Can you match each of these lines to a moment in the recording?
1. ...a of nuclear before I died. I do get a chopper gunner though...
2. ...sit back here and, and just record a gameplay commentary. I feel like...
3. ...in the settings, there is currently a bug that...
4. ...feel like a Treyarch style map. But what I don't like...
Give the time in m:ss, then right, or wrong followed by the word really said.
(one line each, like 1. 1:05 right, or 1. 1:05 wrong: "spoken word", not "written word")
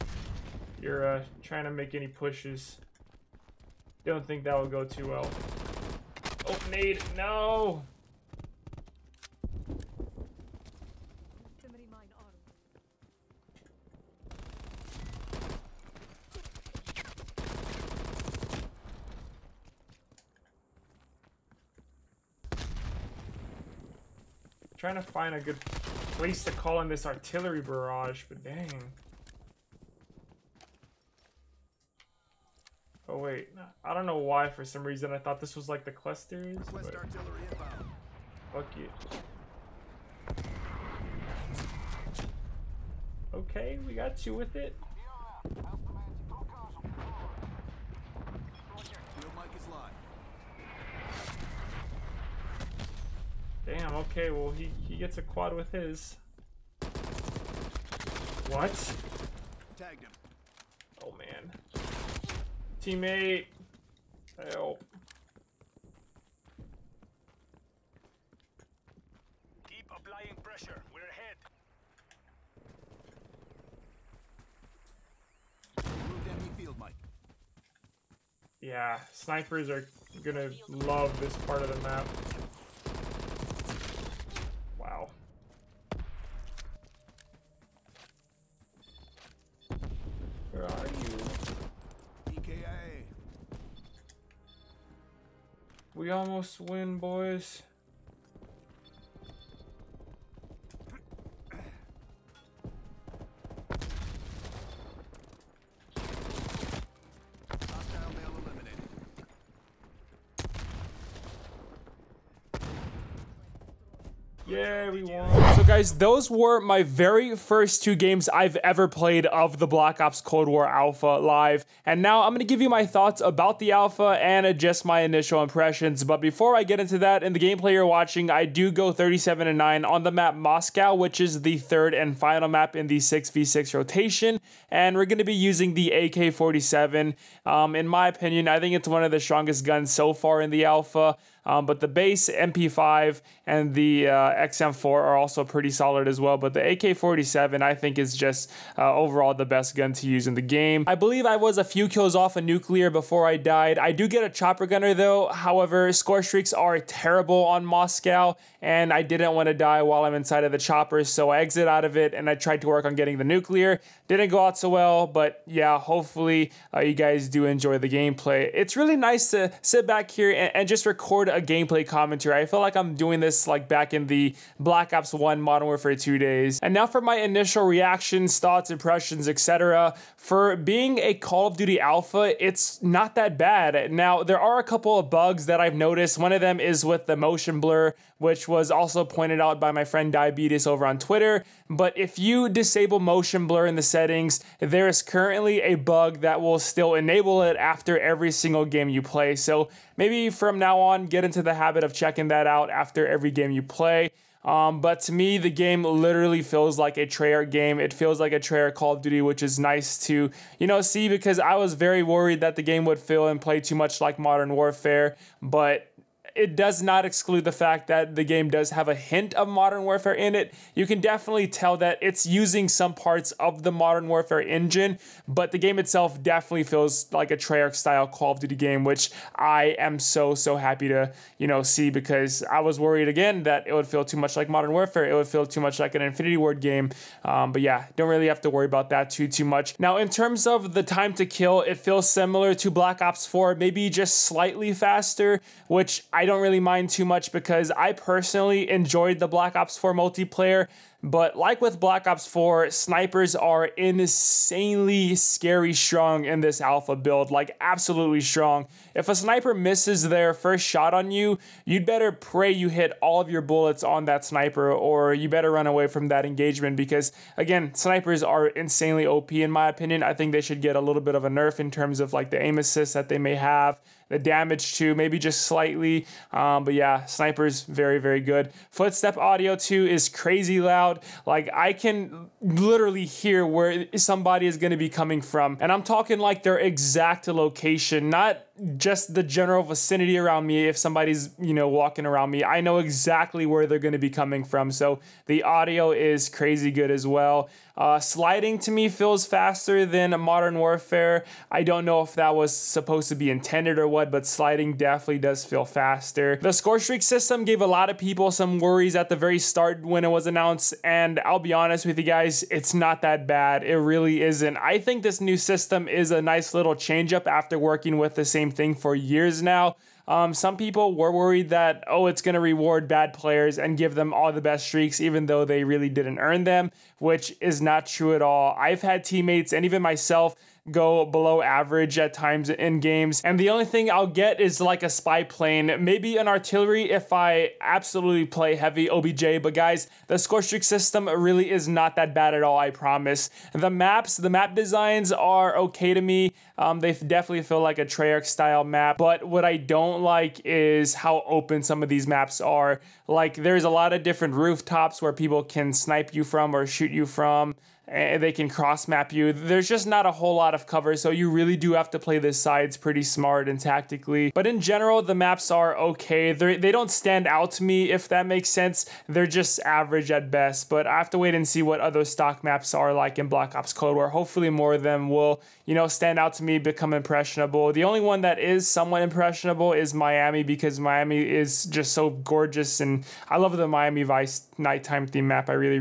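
1. 2:32 right
2. 2:49 right
3. 3:13 right
4. 5:47 right.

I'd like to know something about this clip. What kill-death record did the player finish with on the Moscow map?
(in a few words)
37 and 9.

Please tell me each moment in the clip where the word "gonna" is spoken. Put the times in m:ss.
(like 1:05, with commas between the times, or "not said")
1:20.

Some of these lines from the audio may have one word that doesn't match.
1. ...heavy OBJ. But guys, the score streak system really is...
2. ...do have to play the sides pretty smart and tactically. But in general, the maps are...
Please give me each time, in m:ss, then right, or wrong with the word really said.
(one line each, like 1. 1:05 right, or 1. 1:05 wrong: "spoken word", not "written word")
1. 5:38 right
2. 6:01 right.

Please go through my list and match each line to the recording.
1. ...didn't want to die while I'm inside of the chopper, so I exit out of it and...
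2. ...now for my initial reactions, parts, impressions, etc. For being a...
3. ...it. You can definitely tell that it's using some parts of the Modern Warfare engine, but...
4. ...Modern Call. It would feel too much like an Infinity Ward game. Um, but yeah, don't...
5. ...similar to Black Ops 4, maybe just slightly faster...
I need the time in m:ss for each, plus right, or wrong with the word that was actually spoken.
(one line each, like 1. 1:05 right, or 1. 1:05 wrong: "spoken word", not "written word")
1. 2:39 right
2. 2:56 wrong: "thoughts", not "parts"
3. 3:40 right
4. 3:54 wrong: "Warfare", not "Call"
5. 4:02 right.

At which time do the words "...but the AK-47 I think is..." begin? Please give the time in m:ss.
2:26.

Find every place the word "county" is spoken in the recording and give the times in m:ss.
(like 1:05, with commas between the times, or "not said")
not said.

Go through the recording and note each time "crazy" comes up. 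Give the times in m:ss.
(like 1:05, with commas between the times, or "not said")
4:40, 4:56.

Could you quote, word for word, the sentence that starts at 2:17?
Um, in my opinion, I think it's one of the strongest guns so far in the Alpha.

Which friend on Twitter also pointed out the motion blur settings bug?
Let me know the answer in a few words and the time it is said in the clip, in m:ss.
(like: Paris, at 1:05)
Diabetes, at 3:10.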